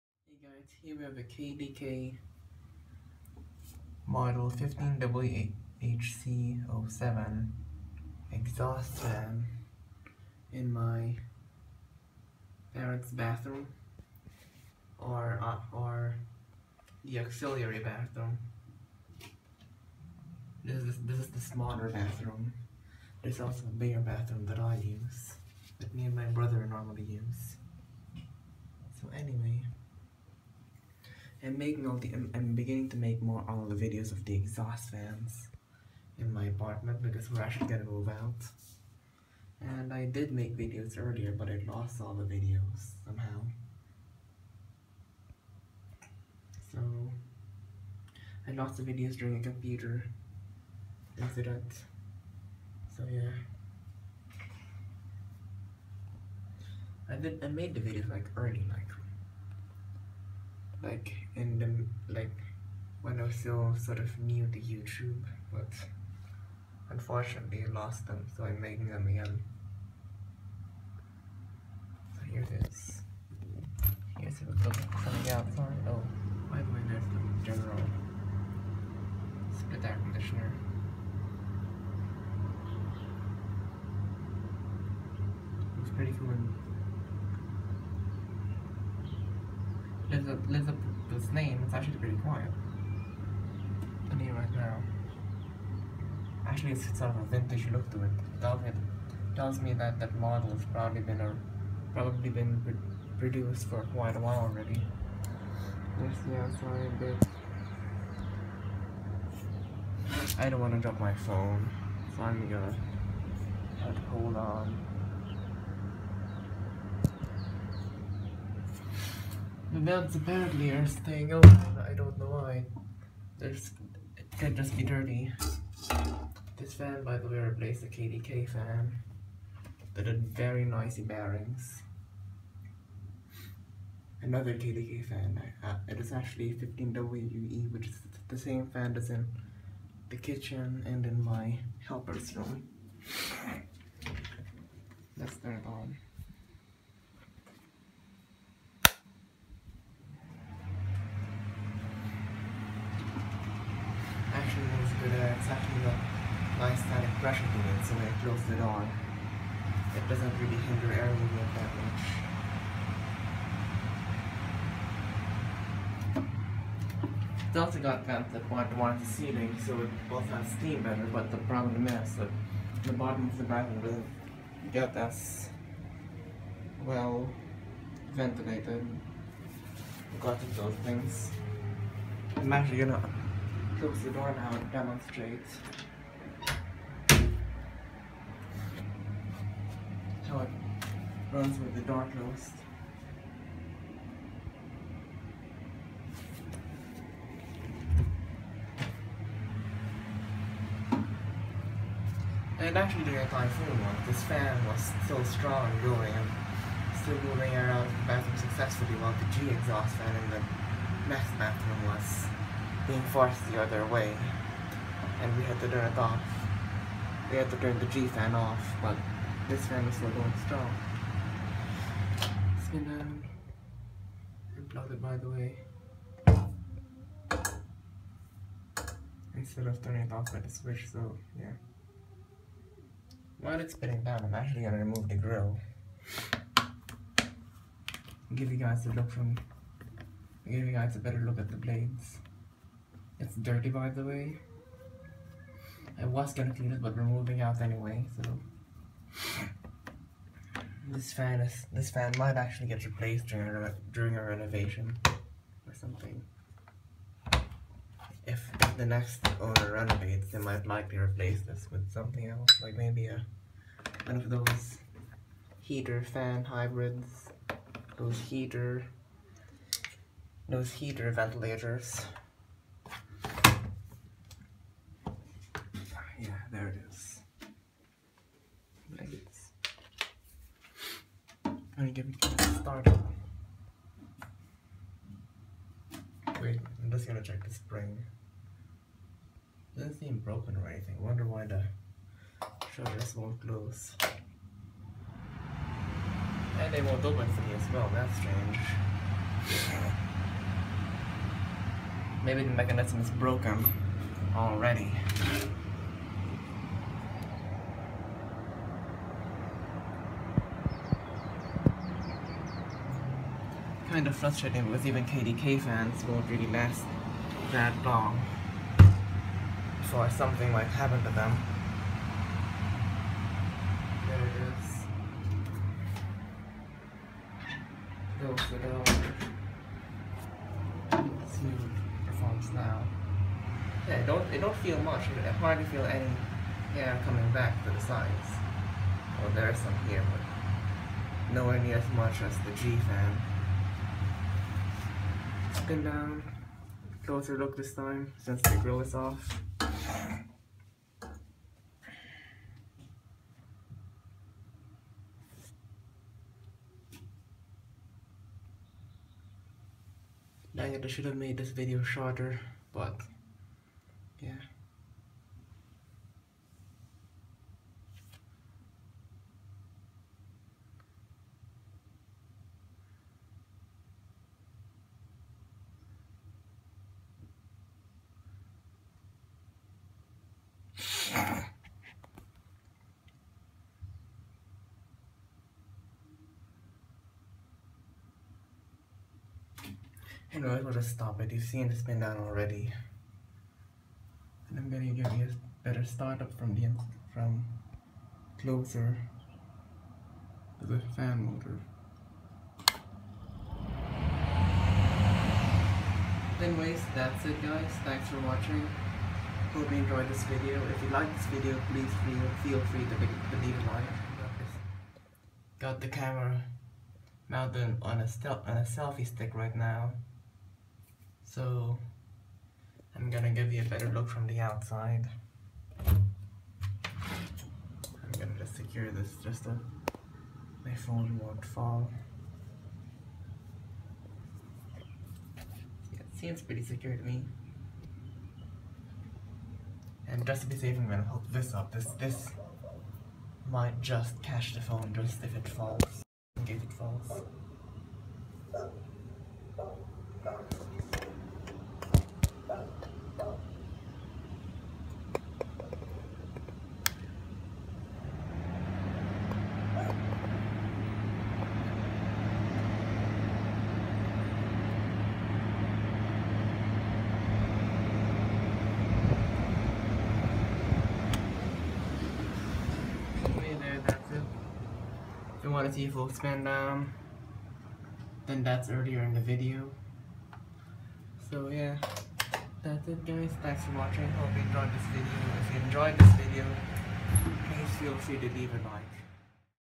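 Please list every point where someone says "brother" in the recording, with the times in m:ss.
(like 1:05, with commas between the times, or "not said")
0:26.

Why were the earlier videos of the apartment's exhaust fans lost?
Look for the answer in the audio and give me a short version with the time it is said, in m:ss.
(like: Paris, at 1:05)
A computer incident, at 0:49.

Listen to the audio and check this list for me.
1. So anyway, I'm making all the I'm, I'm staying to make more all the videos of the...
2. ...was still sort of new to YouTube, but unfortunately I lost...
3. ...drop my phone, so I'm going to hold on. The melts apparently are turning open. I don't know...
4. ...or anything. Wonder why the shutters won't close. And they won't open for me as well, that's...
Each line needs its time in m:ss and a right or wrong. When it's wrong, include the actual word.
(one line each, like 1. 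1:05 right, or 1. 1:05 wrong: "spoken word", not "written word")
1. 0:29 wrong: "beginning", not "staying"
2. 1:03 right
3. 1:50 wrong: "staying", not "turning"
4. 4:50 right.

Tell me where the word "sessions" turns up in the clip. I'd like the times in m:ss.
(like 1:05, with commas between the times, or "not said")
not said.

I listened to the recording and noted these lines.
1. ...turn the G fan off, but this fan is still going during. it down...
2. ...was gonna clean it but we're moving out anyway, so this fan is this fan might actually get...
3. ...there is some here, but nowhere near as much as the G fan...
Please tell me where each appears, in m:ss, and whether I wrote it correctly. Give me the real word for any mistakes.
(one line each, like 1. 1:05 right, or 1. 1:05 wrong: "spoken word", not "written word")
1. 3:37 wrong: "strong", not "during"
2. 4:06 right
3. 5:39 right.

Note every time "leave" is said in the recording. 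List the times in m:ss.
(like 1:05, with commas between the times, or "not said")
6:53, 8:08.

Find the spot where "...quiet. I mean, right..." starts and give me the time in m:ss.
1:32.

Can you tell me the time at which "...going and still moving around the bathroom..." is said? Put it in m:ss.
3:25.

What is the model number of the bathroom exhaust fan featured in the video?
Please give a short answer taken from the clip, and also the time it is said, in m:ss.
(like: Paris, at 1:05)
15WHC07, at 0:04.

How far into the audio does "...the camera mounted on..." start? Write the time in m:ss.
6:55.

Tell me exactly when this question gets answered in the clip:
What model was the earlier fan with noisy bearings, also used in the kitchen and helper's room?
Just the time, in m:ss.
2:16.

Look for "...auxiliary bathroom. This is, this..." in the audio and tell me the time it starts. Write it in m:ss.
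0:17.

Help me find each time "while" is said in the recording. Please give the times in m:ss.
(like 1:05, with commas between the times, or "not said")
1:44, 3:29, 3:53.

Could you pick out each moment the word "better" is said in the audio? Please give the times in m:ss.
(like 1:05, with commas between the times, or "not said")
2:50, 4:00, 6:35, 7:03.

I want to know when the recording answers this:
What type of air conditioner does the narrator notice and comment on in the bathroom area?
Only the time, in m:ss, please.
1:17.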